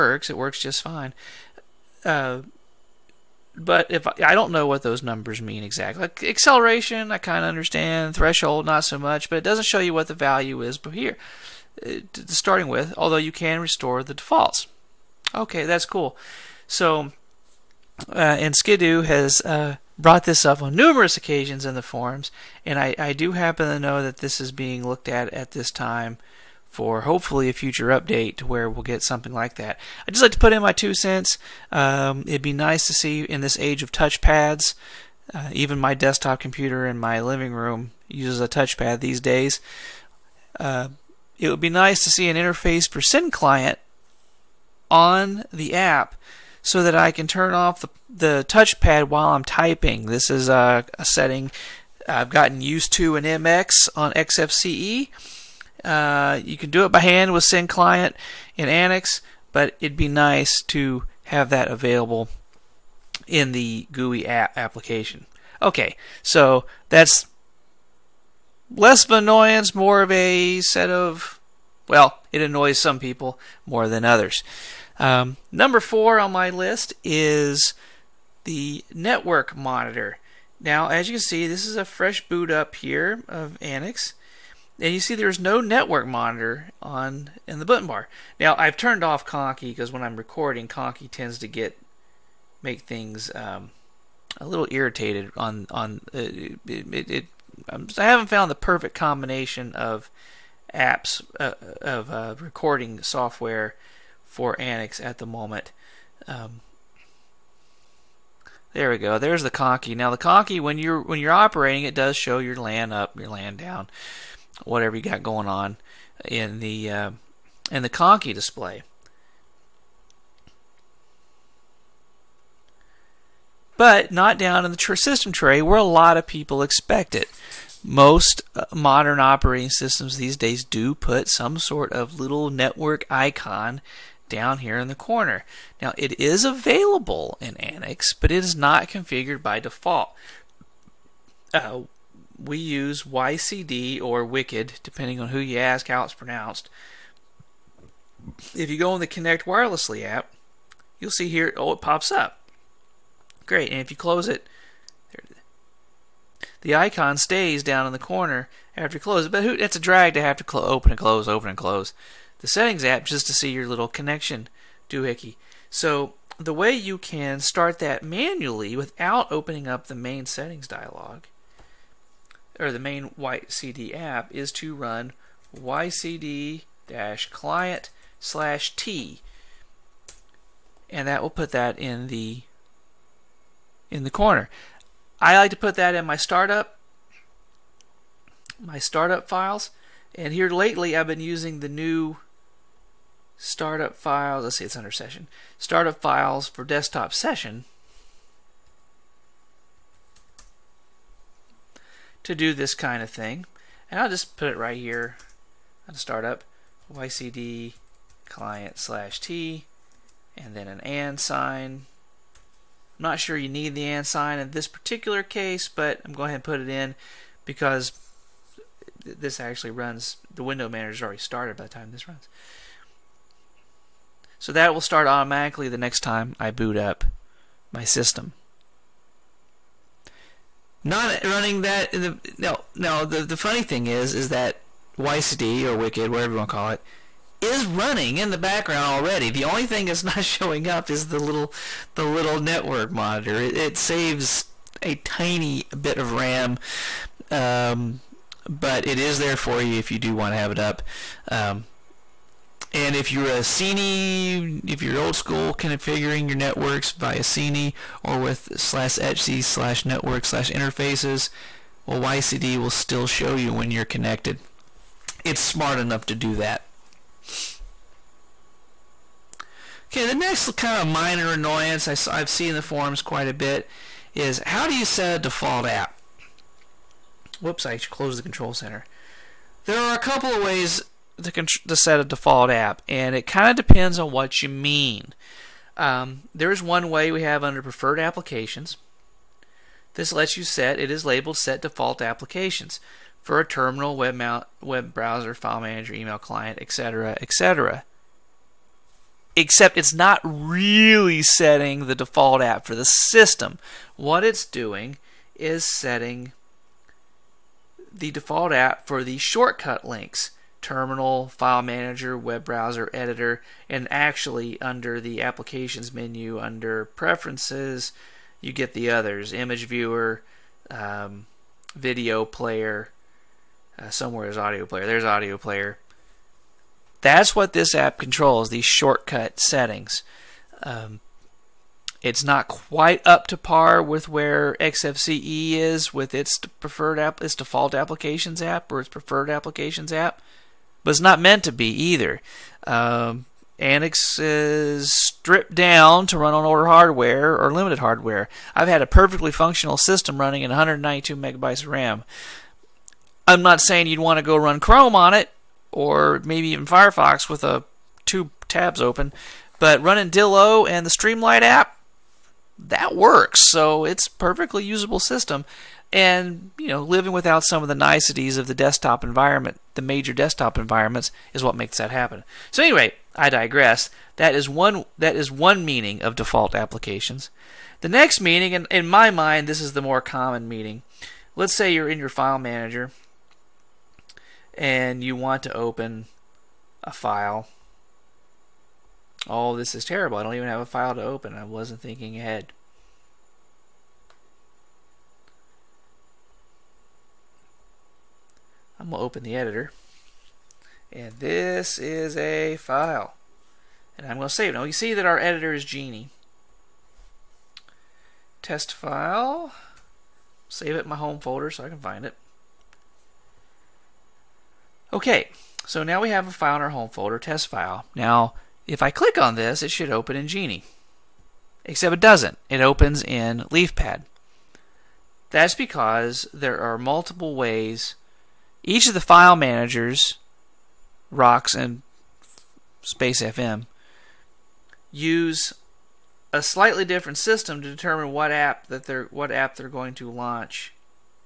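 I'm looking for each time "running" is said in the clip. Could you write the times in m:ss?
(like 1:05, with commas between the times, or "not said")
3:51, 3:57, 5:50, 5:59.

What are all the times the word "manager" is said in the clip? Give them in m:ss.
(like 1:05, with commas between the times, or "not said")
3:40, 4:55, 5:11, 6:22, 7:09.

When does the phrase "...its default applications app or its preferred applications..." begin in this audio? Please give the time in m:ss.
5:37.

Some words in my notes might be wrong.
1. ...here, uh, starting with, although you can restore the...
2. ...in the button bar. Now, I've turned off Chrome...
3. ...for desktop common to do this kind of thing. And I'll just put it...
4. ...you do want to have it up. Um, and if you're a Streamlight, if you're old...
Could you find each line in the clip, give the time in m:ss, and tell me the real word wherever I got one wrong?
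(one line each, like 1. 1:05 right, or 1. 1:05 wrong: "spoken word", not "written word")
1. 0:10 right
2. 1:27 wrong: "Conky", not "Chrome"
3. 3:16 wrong: "session", not "common"
4. 4:09 wrong: "CNI", not "Streamlight".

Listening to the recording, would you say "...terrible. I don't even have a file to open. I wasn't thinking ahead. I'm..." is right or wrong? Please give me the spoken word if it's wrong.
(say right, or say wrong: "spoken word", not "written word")
right.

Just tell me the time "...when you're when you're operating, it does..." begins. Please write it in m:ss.
1:50.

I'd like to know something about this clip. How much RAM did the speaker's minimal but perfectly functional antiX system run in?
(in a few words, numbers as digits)
192 megabytes.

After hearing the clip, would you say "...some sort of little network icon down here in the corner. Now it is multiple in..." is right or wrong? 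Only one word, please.
wrong.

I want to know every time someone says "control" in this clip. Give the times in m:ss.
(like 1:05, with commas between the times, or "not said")
4:38, 5:27.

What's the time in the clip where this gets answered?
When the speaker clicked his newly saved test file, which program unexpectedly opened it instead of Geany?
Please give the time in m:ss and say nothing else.
7:03.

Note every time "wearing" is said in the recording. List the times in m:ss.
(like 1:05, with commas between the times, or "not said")
not said.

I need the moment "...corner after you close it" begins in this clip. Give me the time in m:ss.
2:37.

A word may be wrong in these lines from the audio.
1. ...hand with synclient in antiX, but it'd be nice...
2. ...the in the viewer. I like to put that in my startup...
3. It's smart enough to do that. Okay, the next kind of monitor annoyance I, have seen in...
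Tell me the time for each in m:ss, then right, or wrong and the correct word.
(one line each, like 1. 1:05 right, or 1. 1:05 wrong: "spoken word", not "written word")
1. 0:57 right
2. 3:02 wrong: "corner", not "viewer"
3. 4:25 wrong: "minor", not "monitor".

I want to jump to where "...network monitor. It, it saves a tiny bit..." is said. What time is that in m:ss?
4:02.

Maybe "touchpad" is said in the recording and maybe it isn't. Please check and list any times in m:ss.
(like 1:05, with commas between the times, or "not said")
0:33, 0:38, 0:48.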